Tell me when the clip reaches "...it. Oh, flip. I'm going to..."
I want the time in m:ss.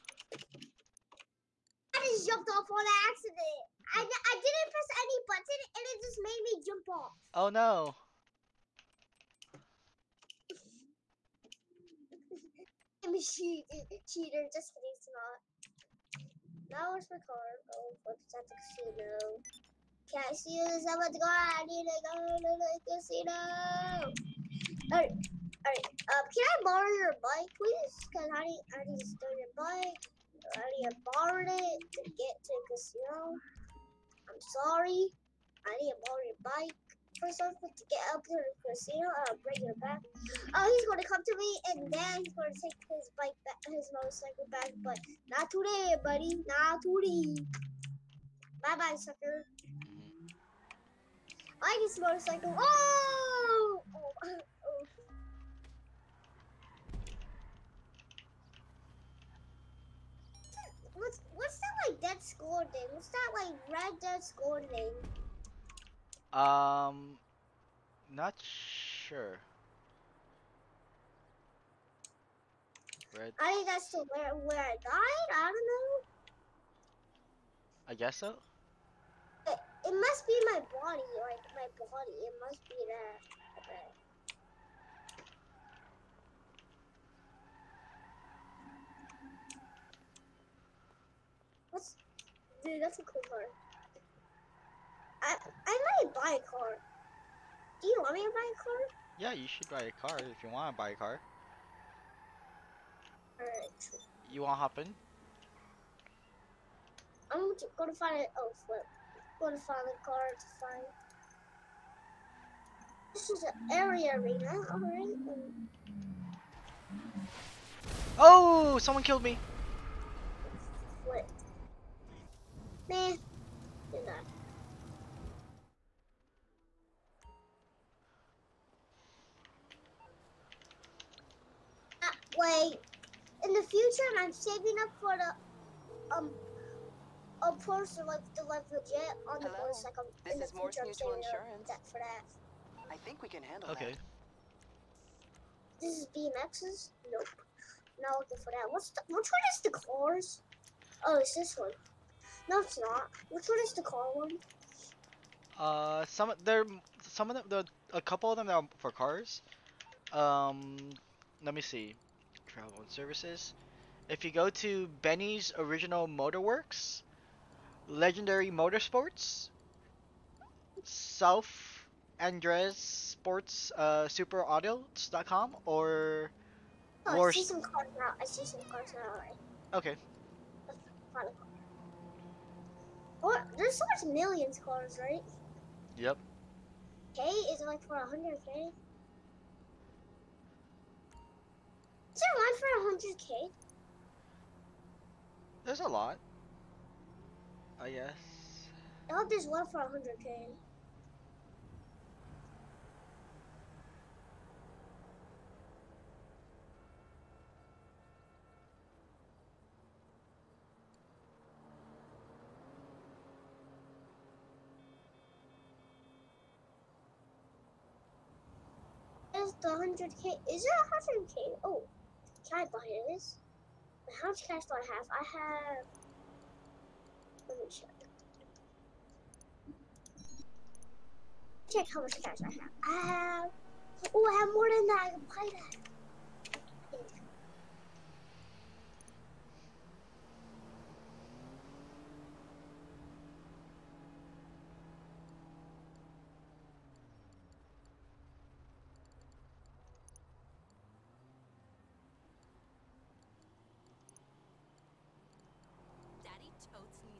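1:48.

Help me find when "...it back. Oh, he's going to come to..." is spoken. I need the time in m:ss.
0:39.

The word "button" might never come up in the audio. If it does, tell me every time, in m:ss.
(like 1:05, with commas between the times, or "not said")
0:05.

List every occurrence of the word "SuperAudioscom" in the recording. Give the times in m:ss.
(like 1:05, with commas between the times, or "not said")
2:54.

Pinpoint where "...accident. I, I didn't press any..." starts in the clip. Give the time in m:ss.
0:03.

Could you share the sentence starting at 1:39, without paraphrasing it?
Yeah, you should buy a car if you want to buy a car.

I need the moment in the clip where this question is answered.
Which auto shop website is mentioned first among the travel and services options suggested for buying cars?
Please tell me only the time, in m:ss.
2:45.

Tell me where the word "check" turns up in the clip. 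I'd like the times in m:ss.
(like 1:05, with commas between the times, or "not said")
3:47, 3:51.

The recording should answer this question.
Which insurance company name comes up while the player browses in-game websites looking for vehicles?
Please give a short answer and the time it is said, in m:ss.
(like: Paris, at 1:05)
Mors Mutual Insurance, at 2:20.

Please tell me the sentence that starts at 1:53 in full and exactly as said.
This is an area arena, alright?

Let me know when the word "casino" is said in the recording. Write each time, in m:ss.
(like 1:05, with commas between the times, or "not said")
0:18, 0:24, 0:32, 0:38.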